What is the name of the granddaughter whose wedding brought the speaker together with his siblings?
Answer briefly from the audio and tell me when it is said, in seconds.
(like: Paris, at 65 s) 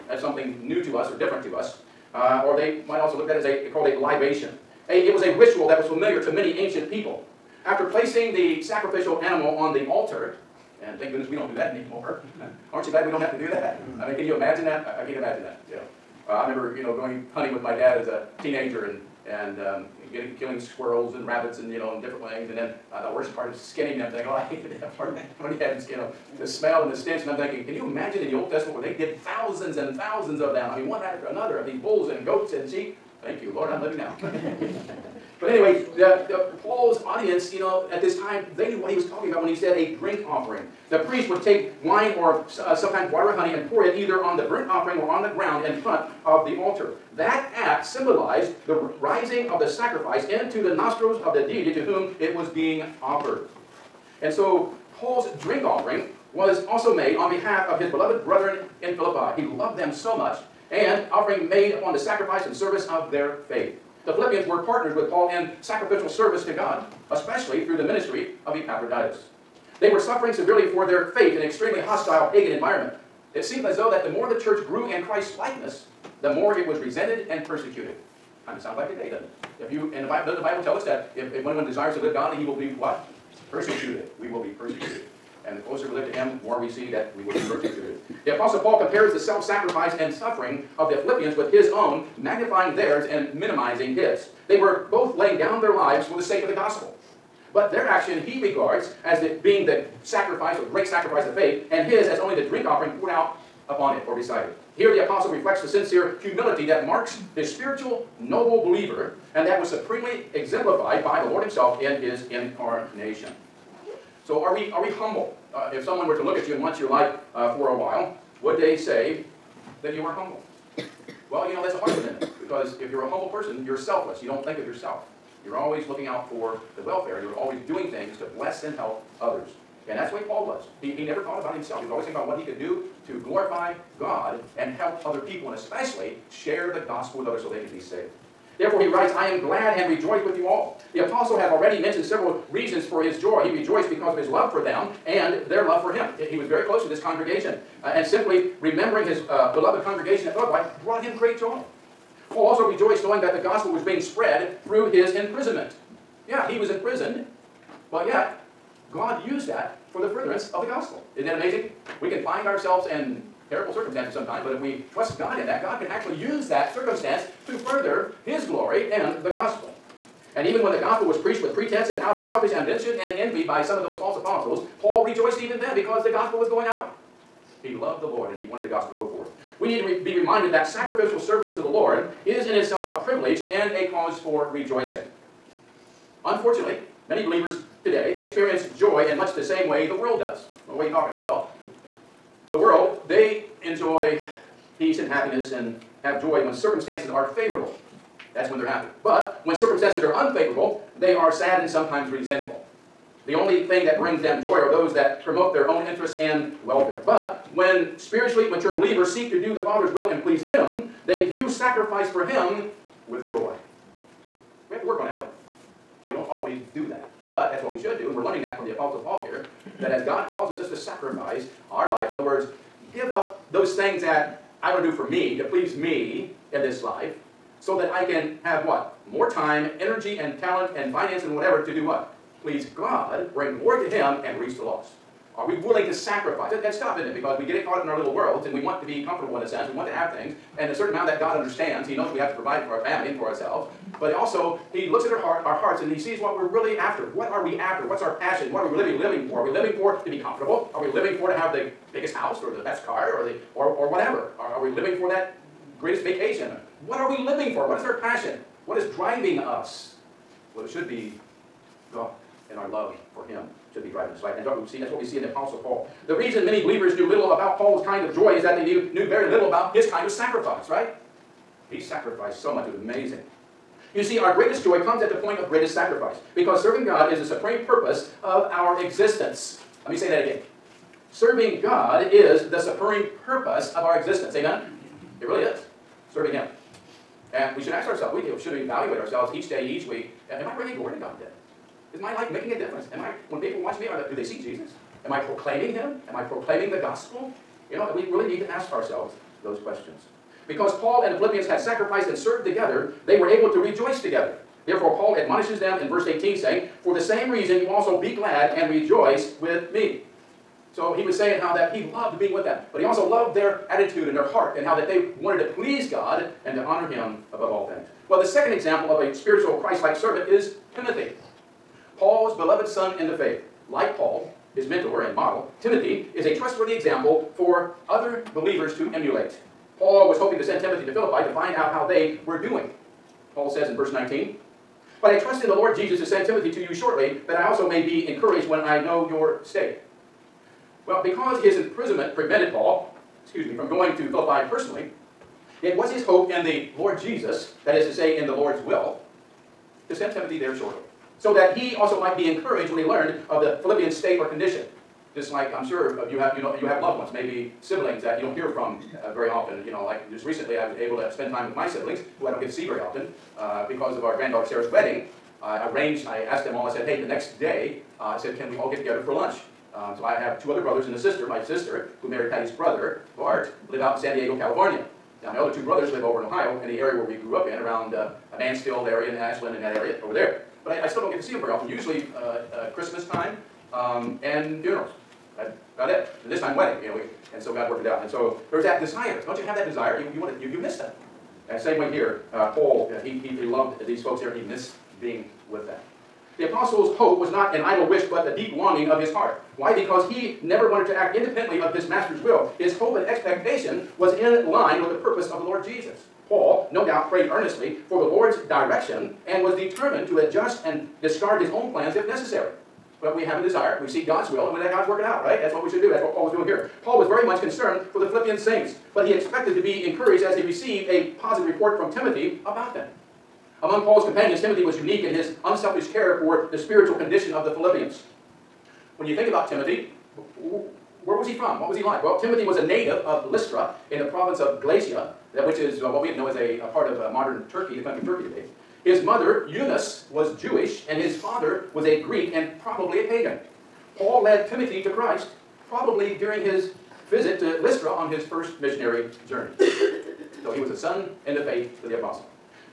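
Sarah, at 364 s.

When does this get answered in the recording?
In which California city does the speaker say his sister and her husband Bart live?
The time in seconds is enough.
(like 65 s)
374 s.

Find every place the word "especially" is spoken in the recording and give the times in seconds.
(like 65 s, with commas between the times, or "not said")
67 s, 135 s.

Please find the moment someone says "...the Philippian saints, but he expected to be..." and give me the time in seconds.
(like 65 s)
417 s.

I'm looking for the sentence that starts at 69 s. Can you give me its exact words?
They were suffering severely for their faith in an extremely hostile pagan environment.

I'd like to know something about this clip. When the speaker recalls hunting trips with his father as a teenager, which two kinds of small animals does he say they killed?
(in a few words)
squirrels and rabbits.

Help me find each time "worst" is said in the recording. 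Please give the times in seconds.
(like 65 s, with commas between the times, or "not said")
23 s.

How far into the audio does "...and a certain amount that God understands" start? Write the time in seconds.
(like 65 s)
240 s.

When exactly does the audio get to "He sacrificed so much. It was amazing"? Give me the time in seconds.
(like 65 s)
271 s.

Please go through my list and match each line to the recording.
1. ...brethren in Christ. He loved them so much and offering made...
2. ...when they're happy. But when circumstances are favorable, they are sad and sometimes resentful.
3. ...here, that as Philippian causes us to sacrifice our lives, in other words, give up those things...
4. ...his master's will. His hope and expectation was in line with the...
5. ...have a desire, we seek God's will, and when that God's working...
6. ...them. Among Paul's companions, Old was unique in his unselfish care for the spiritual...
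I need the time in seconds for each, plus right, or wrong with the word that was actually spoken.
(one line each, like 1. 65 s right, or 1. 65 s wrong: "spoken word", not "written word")
1. 58 s wrong: "Philippi", not "Christ"
2. 198 s wrong: "unfavorable", not "favorable"
3. 219 s wrong: "God", not "Philippian"
4. 401 s right
5. 413 s right
6. 422 s wrong: "Timothy", not "Old".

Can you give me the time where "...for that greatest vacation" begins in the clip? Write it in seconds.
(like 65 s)
255 s.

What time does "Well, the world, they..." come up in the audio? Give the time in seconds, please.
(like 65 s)
191 s.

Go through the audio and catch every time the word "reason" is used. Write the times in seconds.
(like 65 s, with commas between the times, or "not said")
142 s, 266 s, 307 s.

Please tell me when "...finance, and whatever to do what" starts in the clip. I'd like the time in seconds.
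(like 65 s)
230 s.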